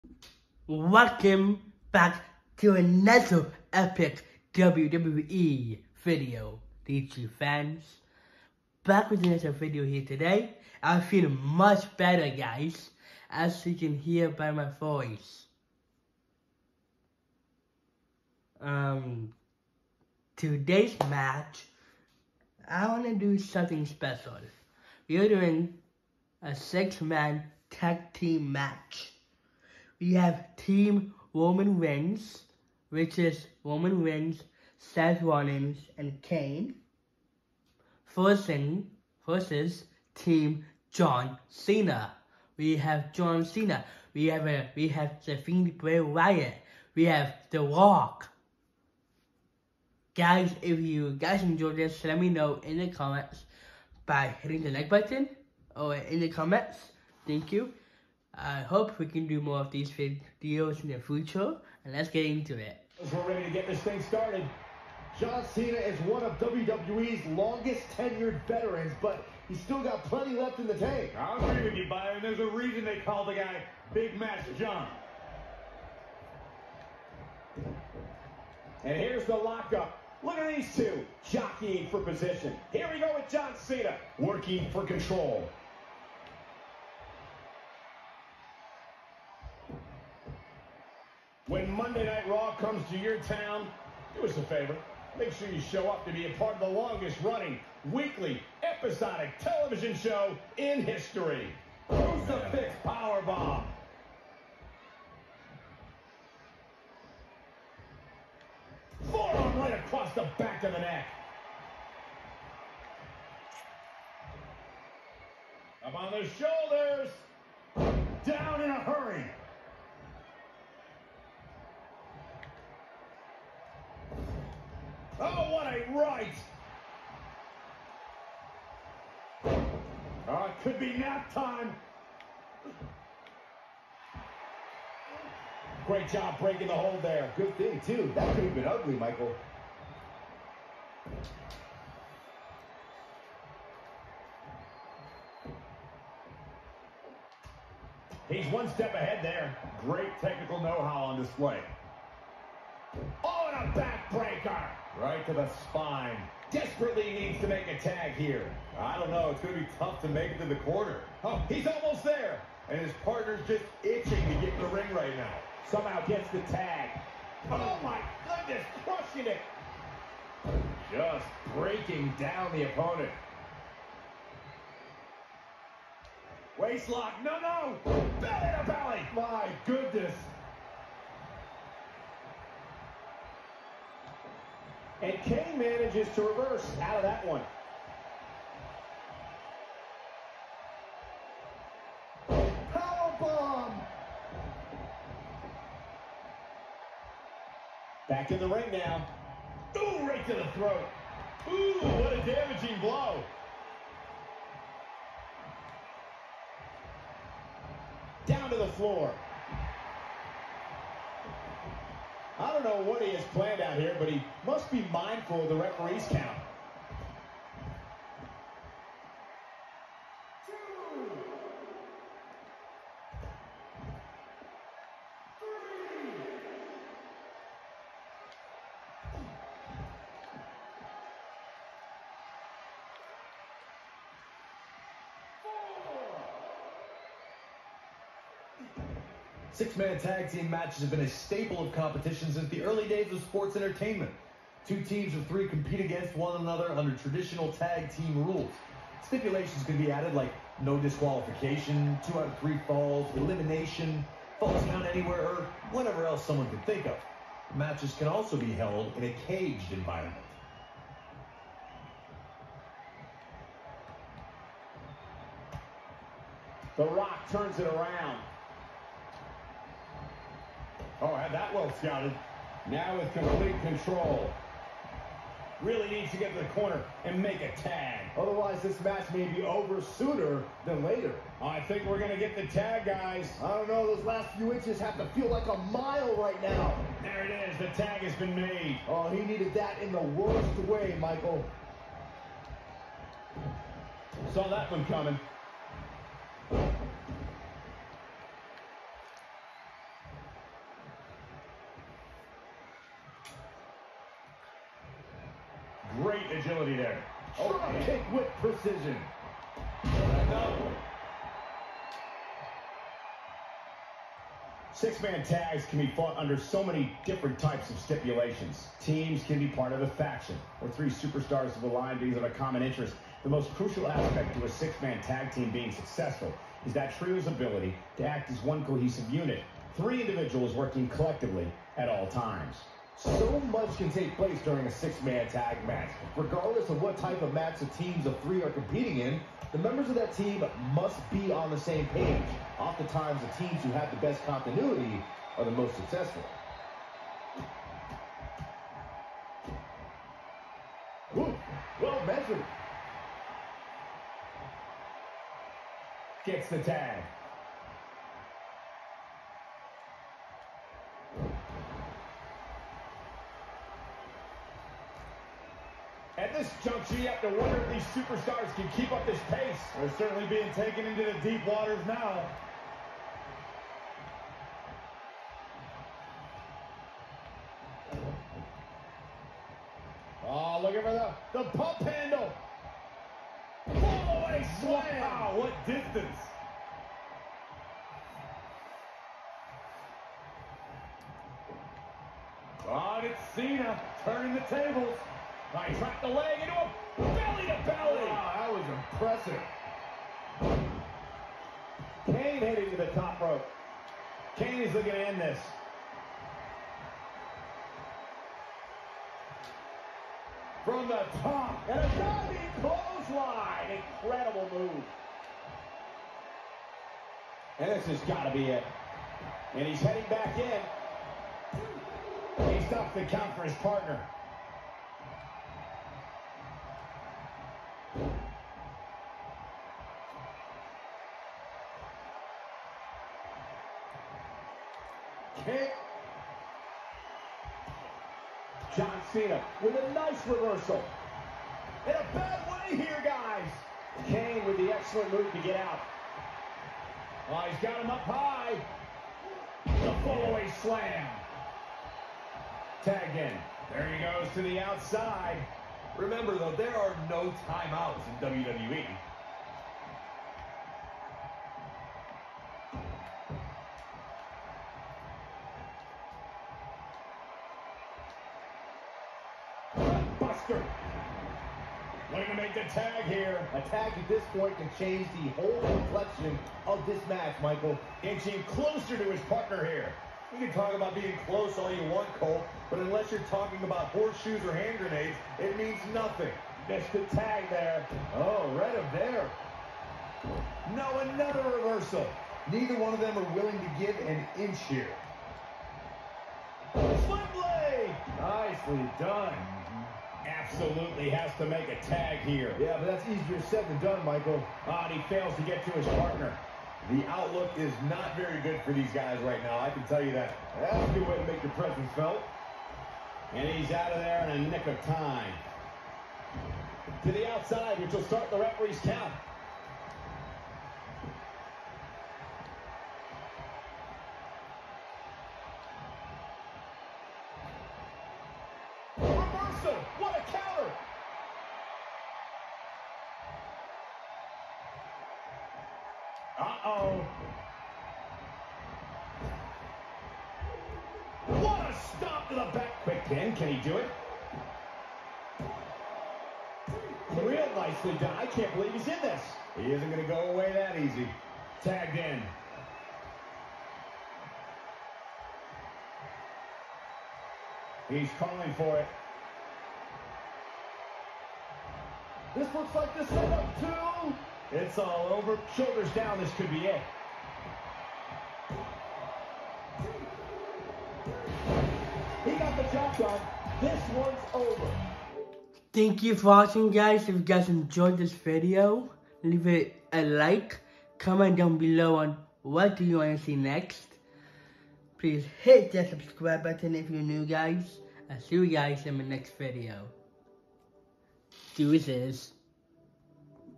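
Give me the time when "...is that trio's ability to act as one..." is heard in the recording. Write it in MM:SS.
05:26.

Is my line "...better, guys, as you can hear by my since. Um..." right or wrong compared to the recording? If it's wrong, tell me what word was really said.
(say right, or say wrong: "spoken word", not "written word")
wrong: "voice", not "since".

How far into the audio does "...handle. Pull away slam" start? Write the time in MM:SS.
06:21.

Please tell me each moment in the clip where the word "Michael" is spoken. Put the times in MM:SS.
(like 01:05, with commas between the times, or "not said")
02:18, 04:50, 07:57, 08:24.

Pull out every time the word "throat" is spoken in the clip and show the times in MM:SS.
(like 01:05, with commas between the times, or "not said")
03:20.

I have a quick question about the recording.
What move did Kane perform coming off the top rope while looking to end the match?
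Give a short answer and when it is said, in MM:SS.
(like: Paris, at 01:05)
diving clothesline, at 06:51.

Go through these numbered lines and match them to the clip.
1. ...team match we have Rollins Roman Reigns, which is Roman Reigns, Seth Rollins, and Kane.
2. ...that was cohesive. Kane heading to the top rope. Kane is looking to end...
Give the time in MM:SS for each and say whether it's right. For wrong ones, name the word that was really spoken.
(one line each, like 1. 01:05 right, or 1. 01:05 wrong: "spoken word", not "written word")
1. 00:28 wrong: "Team", not "Rollins"
2. 06:38 wrong: "impressive", not "cohesive".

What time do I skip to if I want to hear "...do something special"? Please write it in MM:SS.
00:23.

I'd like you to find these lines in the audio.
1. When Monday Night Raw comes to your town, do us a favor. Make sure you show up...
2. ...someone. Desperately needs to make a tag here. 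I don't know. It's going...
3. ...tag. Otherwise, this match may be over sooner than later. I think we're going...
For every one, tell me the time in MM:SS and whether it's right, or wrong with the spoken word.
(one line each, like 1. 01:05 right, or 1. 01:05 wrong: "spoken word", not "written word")
1. 01:31 right
2. 02:35 wrong: "spine", not "someone"
3. 04:37 right.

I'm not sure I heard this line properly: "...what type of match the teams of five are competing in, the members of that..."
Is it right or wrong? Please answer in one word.
wrong.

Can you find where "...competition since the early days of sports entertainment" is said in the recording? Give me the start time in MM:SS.
04:01.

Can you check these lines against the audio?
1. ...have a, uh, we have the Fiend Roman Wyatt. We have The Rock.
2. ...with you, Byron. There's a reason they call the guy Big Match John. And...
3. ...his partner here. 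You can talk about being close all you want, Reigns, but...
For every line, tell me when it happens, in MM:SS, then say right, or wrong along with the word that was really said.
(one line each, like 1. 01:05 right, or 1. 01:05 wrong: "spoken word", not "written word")
1. 00:44 wrong: "Bray", not "Roman"
2. 01:11 right
3. 07:59 wrong: "Cole", not "Reigns".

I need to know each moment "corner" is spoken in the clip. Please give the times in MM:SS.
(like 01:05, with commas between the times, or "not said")
02:40, 04:36.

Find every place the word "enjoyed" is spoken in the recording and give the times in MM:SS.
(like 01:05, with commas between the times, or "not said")
00:51, 09:37.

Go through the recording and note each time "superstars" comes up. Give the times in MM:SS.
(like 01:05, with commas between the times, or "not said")
05:20, 06:08.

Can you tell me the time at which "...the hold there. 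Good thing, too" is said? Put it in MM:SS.
02:16.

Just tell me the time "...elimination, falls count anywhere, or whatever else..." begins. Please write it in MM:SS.
04:13.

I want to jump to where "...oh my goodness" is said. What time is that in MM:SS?
02:47.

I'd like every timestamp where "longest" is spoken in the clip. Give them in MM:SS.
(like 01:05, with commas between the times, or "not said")
01:07, 01:36.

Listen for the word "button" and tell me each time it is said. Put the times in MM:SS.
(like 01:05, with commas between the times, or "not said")
00:54, 09:46.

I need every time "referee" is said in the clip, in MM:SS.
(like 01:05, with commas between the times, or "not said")
03:35, 08:38.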